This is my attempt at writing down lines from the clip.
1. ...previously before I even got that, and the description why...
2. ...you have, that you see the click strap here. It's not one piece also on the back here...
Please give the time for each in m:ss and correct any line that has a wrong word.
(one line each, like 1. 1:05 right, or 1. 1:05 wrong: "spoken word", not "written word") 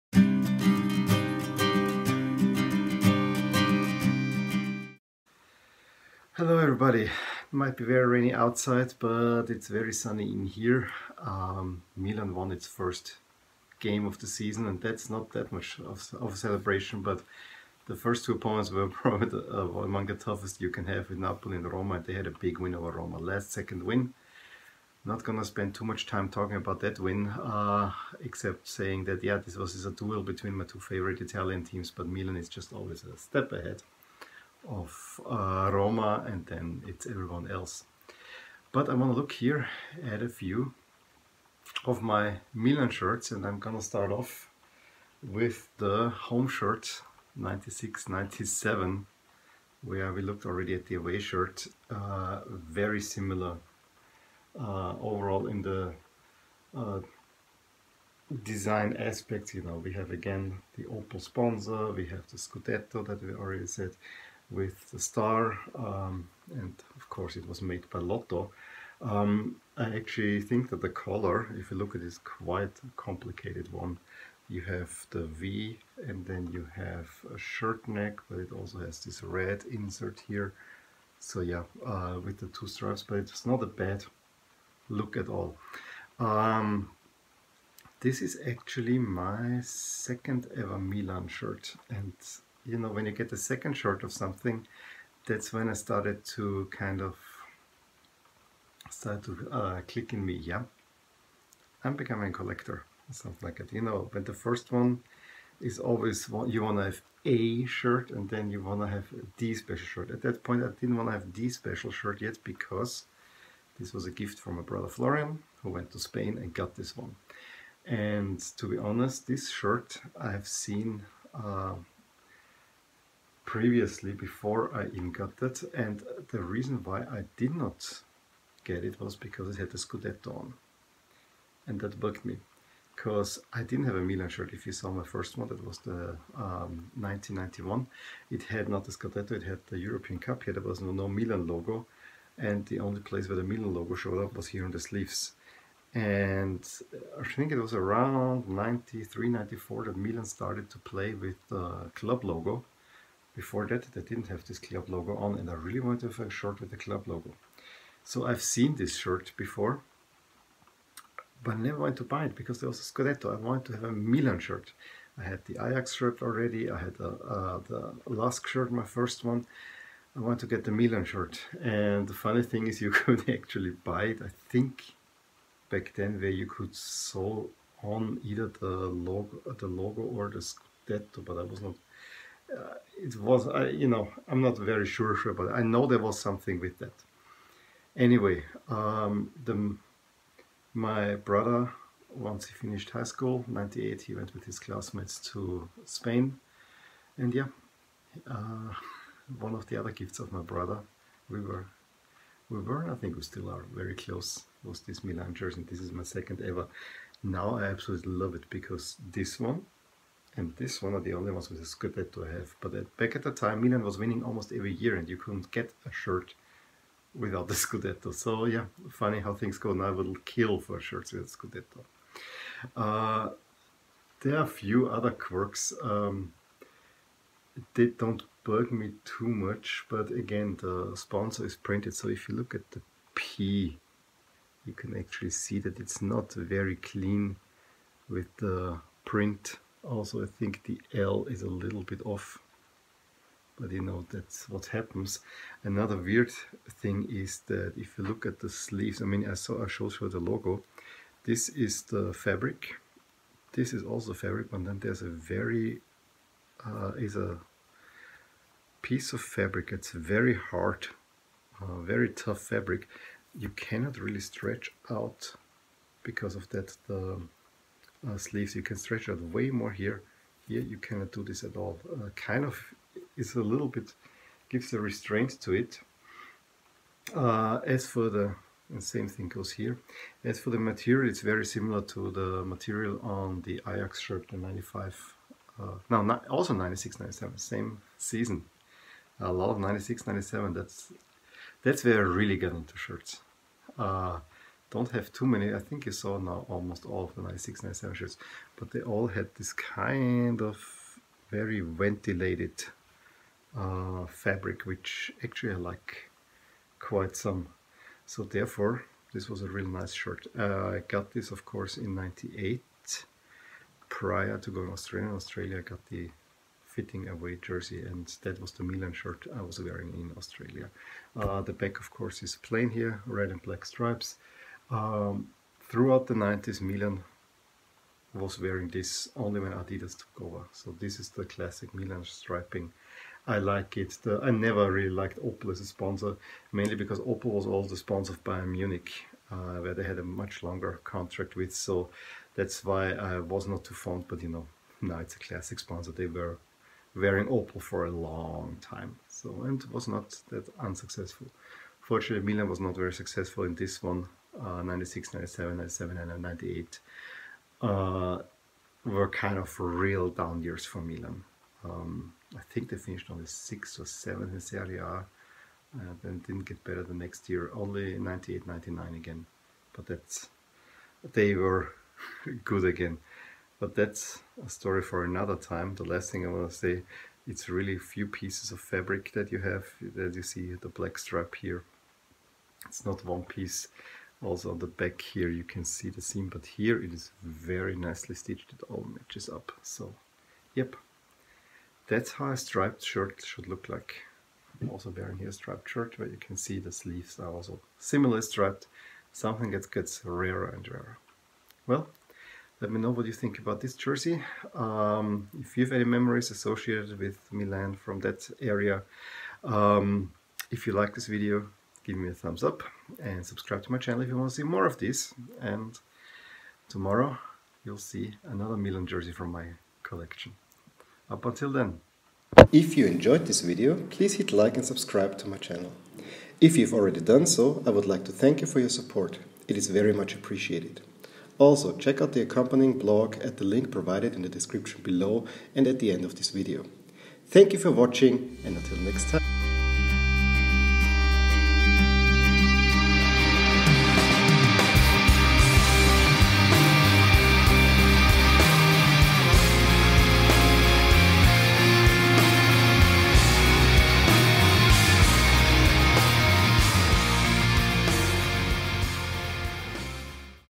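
1. 2:03 wrong: "reason", not "description"
2. 6:19 wrong: "black", not "click".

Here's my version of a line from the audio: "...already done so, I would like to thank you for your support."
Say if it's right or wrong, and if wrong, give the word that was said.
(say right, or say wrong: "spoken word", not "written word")
right.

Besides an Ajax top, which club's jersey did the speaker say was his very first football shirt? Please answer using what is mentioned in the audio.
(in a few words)
Lask.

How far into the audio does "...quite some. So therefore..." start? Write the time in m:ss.
5:06.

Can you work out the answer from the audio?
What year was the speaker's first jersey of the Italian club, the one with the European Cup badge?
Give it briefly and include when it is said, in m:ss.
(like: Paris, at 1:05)
1991, at 2:17.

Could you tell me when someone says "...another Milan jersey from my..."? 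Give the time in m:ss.
6:58.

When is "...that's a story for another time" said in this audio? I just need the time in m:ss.
6:13.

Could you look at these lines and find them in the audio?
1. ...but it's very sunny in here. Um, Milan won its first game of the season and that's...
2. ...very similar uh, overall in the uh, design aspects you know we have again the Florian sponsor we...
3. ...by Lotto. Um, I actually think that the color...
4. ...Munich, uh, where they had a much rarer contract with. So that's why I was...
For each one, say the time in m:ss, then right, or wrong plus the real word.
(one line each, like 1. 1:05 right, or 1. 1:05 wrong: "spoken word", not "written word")
1. 0:08 right
2. 0:52 wrong: "Opel", not "Florian"
3. 1:07 right
4. 5:38 wrong: "longer", not "rarer".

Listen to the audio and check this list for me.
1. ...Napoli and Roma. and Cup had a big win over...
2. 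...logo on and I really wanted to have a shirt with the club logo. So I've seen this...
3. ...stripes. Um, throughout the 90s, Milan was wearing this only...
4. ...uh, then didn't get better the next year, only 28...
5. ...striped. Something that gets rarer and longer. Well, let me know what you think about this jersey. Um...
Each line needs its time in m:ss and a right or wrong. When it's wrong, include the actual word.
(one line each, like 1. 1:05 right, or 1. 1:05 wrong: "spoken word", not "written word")
1. 0:21 wrong: "They", not "Cup"
2. 2:34 right
3. 5:23 right
4. 6:05 wrong: "98", not "28"
5. 6:38 wrong: "rarer", not "longer".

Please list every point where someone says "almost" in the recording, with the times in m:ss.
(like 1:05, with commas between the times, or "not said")
3:34, 4:56.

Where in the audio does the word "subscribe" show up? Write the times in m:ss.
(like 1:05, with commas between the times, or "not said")
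6:53, 7:04.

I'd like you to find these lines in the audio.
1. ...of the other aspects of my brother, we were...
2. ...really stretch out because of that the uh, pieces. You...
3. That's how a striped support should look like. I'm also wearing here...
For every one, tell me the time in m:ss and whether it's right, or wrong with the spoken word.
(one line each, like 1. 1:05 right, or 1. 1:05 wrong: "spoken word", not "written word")
1. 3:19 wrong: "gifts", not "aspects"
2. 4:23 wrong: "sleeves", not "pieces"
3. 6:31 wrong: "shirt", not "support".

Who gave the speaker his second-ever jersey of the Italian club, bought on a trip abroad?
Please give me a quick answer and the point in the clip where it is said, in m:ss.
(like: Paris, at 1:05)
Florian, at 1:54.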